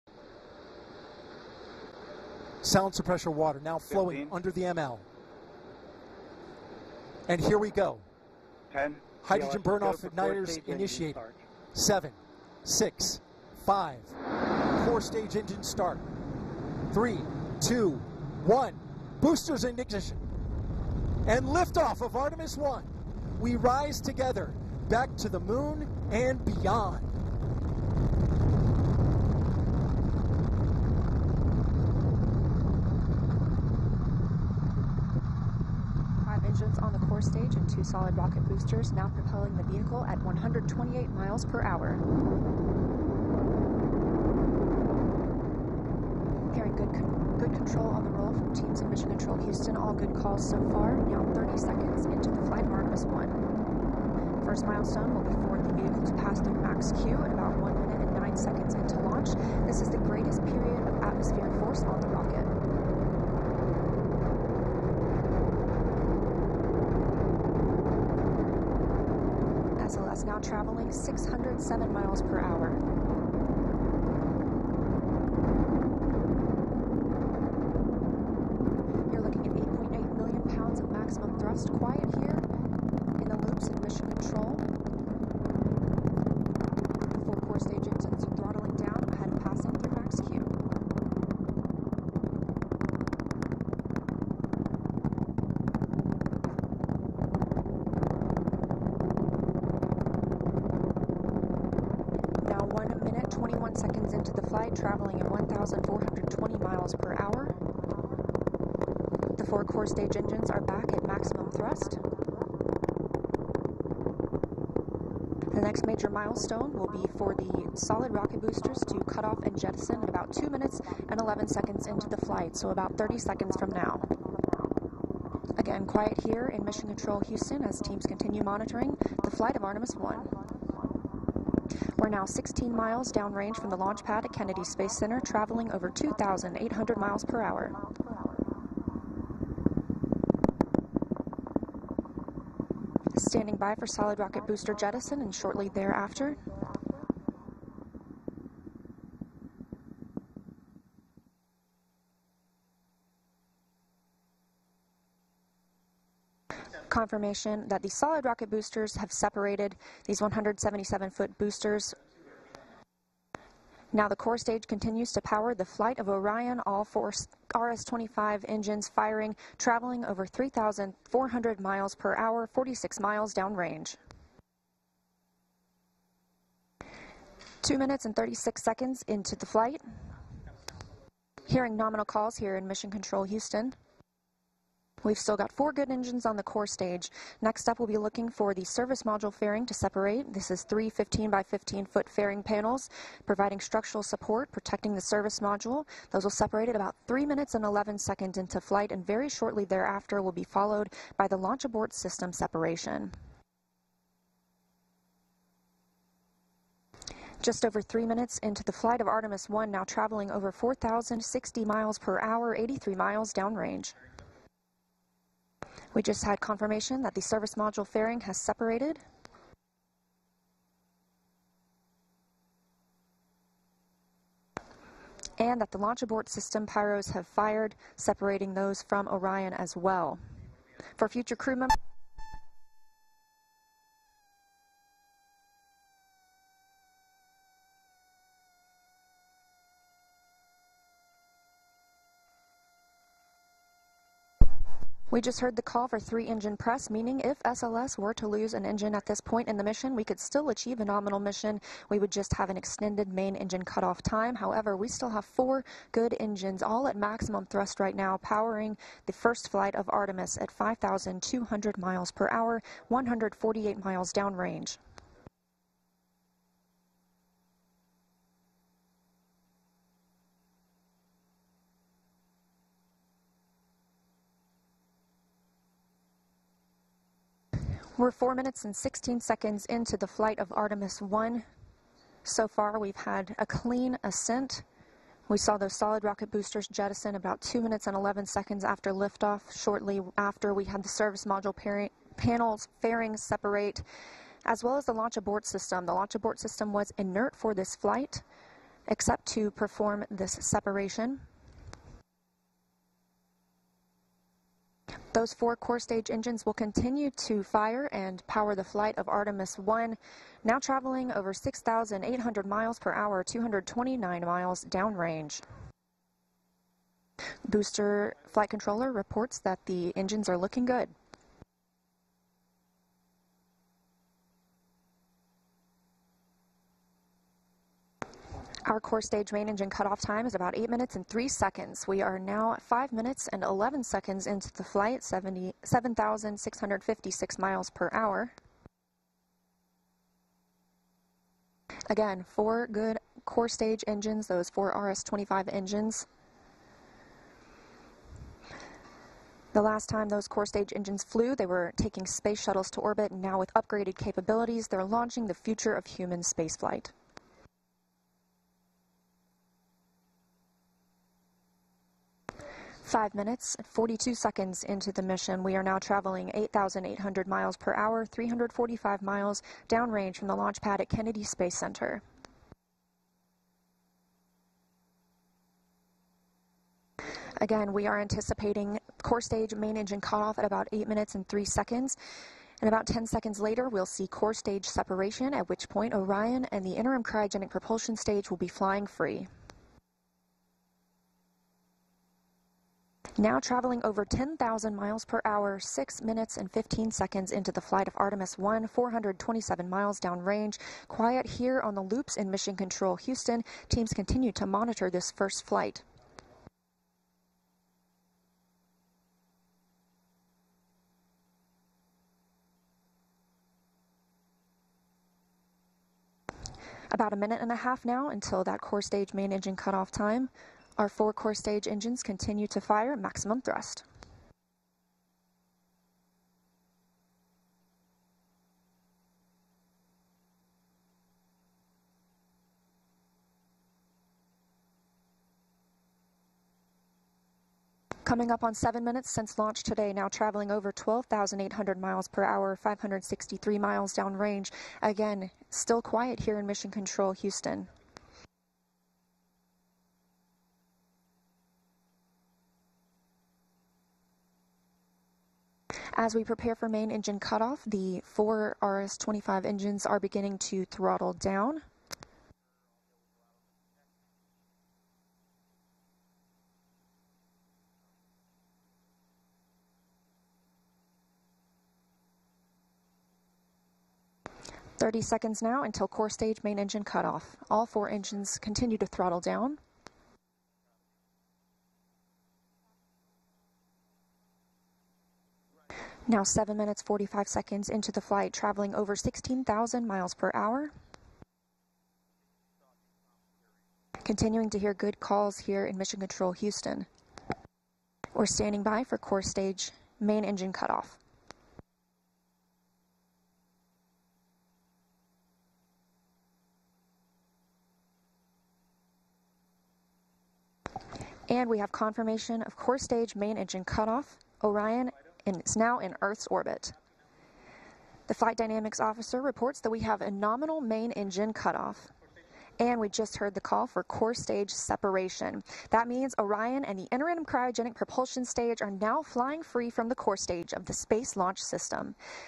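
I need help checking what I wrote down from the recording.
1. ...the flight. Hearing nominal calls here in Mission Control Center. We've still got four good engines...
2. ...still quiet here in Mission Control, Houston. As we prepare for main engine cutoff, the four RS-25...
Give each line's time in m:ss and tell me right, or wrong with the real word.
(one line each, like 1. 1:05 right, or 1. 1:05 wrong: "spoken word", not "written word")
1. 2:59 wrong: "Houston", not "Center"
2. 7:25 right.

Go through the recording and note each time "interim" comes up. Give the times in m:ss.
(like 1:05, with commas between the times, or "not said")
6:26, 8:46.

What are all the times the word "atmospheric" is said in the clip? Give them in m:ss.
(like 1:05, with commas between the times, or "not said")
1:01.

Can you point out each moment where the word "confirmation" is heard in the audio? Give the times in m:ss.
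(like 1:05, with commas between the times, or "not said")
2:36, 3:36, 8:31.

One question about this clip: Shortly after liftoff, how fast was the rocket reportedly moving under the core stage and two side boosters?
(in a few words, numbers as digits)
128 miles per hour.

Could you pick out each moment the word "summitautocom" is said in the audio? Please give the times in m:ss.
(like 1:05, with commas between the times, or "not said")
not said.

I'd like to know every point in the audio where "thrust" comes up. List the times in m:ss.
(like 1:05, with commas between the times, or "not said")
1:51, 4:17, 7:03.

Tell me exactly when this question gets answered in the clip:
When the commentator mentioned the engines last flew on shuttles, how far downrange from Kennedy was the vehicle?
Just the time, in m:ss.
6:08.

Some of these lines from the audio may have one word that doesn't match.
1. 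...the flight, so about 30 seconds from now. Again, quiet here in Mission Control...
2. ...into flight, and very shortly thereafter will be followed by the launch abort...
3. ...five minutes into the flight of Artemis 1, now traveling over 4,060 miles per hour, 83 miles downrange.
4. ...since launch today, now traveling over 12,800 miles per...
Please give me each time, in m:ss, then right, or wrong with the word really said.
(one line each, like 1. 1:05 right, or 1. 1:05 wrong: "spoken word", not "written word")
1. 2:02 right
2. 3:18 right
3. 3:27 wrong: "three", not "five"
4. 7:19 right.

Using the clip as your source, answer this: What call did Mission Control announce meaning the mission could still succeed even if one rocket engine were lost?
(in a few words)
three engine press.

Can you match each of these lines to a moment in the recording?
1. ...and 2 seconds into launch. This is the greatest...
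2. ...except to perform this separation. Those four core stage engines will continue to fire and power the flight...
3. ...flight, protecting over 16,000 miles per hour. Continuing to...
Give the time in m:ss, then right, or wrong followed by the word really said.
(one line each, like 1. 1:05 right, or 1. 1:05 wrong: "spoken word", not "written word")
1. 0:58 wrong: "9", not "2"
2. 4:58 right
3. 8:08 wrong: "traveling", not "protecting".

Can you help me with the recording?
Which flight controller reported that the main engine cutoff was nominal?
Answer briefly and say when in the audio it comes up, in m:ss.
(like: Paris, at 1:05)
flight dynamics officer, at 8:38.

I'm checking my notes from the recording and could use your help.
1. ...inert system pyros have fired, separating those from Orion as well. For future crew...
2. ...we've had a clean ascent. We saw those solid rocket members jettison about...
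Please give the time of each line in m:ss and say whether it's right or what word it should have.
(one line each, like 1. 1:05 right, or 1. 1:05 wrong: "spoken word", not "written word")
1. 3:46 wrong: "abort", not "inert"
2. 4:42 wrong: "boosters", not "members".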